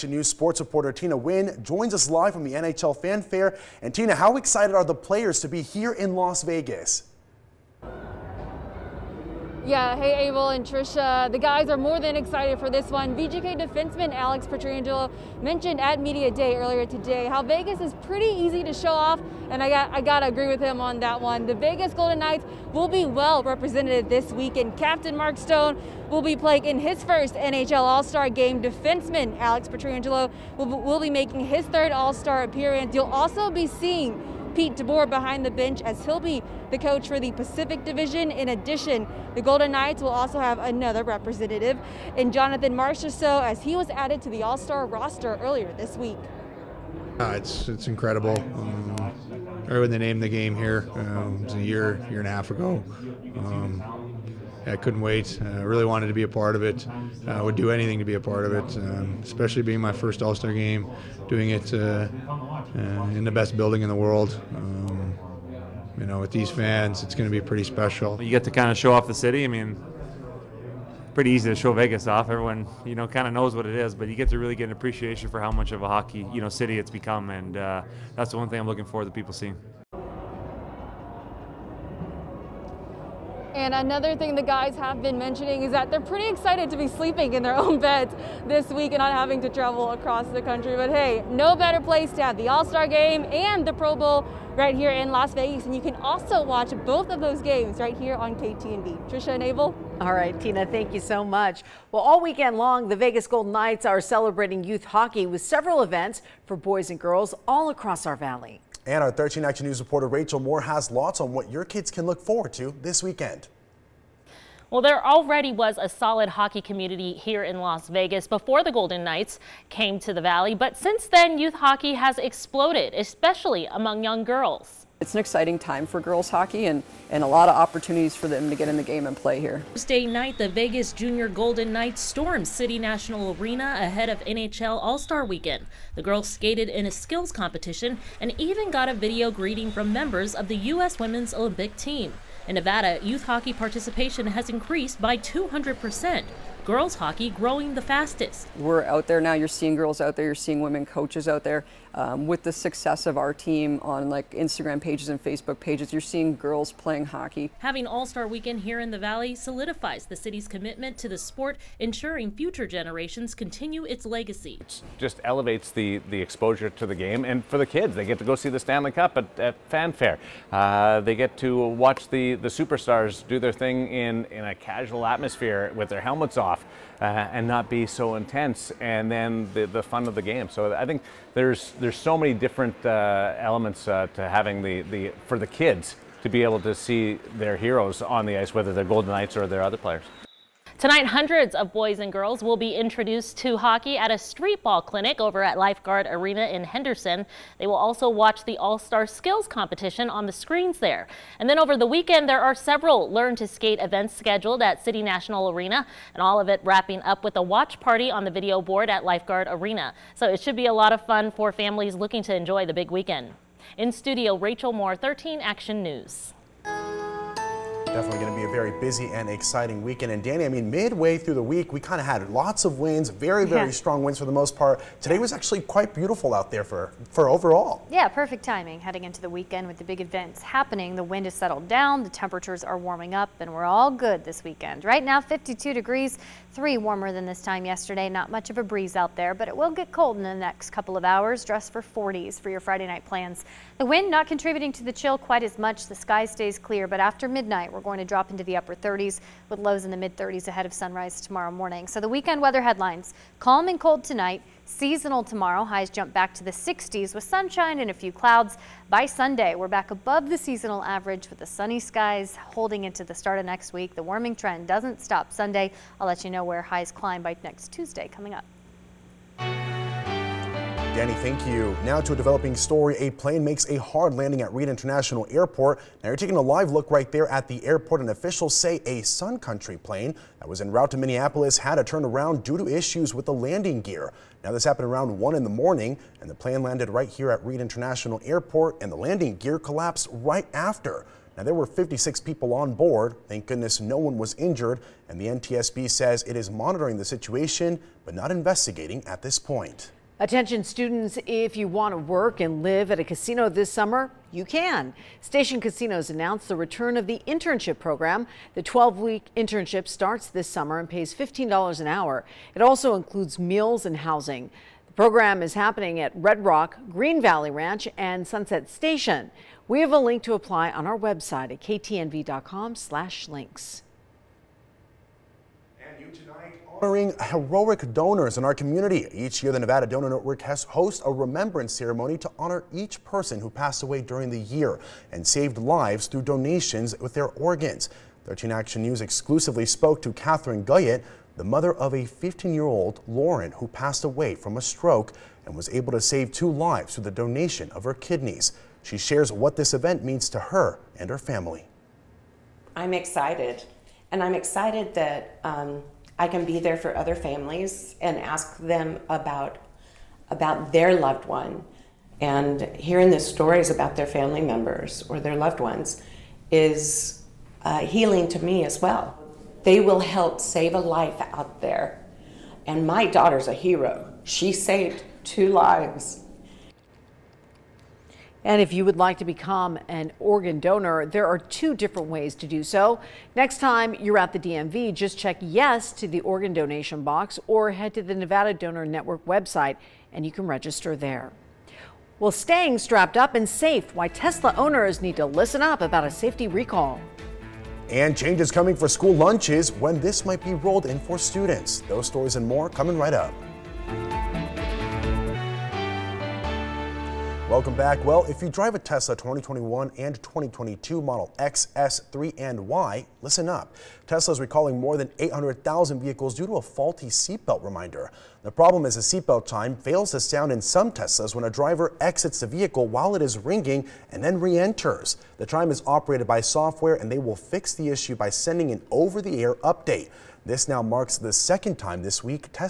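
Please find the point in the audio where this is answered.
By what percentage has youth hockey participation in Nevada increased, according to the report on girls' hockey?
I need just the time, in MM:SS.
02:25.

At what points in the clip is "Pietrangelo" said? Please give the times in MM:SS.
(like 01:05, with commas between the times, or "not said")
00:14, 00:29.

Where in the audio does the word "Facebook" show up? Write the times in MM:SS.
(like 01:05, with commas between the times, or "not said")
02:35.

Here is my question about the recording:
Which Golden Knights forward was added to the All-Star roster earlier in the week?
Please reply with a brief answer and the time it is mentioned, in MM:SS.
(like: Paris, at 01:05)
Jonathan Marchessault, at 00:42.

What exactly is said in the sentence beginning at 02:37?
Having All-Star Weekend here in the Valley solidifies the city's commitment to the sport, ensuring future generations continue its legacy.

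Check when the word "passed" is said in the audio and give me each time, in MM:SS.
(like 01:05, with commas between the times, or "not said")
05:33, 05:43.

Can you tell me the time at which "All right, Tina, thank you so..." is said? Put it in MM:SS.
01:40.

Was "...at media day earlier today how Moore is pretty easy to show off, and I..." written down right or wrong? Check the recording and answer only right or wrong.
wrong.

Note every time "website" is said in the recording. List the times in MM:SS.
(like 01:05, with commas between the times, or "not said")
05:20, 06:29.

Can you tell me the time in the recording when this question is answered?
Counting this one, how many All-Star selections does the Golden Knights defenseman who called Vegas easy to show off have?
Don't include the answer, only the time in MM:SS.
00:31.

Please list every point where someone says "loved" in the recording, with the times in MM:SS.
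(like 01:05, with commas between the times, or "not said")
06:00, 06:05.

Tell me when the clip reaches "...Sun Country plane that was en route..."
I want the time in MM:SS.
04:39.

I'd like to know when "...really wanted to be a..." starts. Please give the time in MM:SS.
00:55.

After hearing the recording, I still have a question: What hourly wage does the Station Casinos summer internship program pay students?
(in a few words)
$15.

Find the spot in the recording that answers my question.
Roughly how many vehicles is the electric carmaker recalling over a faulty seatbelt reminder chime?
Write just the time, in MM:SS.
06:55.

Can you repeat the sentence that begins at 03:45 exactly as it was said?
Today was actually quite beautiful out there for, for overall.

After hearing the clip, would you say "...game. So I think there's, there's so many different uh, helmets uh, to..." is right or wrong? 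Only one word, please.
wrong.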